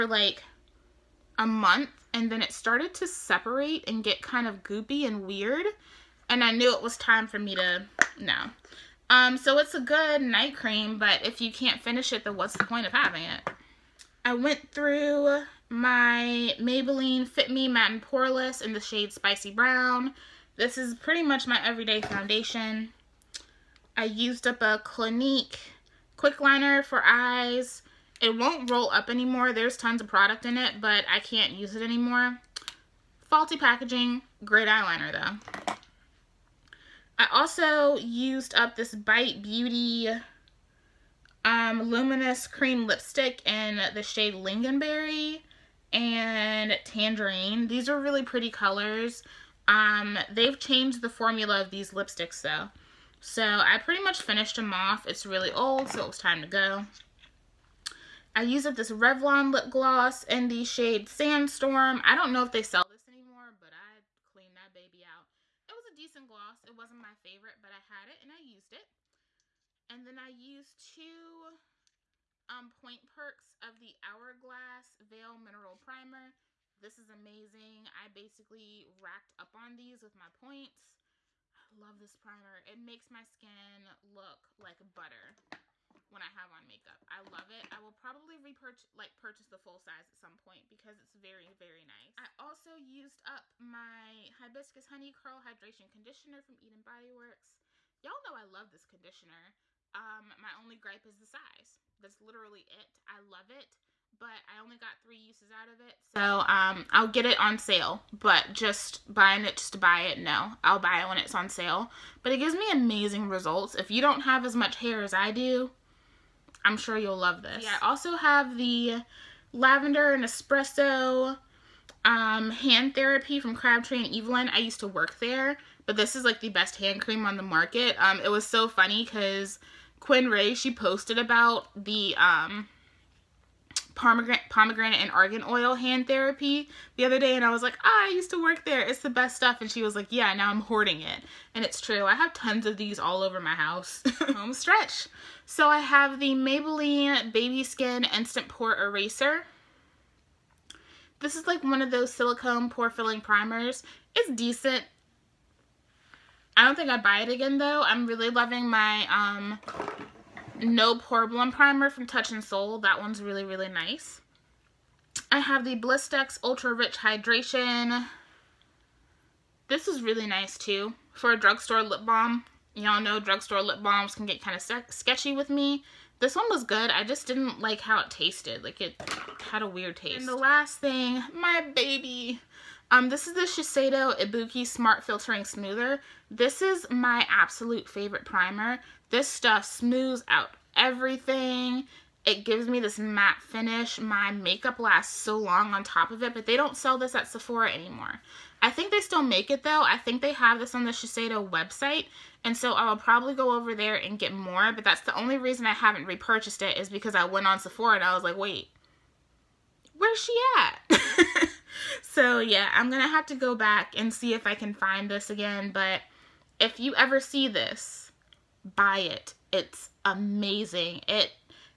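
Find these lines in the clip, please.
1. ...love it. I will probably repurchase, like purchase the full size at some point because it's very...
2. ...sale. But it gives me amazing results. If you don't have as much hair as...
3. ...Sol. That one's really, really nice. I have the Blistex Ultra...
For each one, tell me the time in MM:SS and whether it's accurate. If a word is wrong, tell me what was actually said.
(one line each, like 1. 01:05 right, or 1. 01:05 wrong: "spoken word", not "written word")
1. 01:27 right
2. 01:51 right
3. 02:42 right.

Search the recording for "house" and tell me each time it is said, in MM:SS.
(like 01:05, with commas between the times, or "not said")
02:23.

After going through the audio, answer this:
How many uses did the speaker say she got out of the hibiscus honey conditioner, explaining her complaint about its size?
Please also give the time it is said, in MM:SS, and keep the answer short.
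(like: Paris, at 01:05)
3, at 01:45.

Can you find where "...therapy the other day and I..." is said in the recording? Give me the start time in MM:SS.
02:16.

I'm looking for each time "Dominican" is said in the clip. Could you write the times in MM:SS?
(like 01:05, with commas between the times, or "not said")
not said.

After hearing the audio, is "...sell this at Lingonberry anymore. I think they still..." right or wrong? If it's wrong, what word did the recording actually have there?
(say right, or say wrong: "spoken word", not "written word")
wrong: "Sephora", not "Lingonberry".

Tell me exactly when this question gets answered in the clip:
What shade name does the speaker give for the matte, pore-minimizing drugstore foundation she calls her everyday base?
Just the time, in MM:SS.
00:19.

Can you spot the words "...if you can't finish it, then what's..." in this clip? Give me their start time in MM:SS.
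00:11.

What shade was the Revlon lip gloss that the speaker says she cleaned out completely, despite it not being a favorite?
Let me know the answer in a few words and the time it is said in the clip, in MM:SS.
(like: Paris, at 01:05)
Sandstorm, at 01:01.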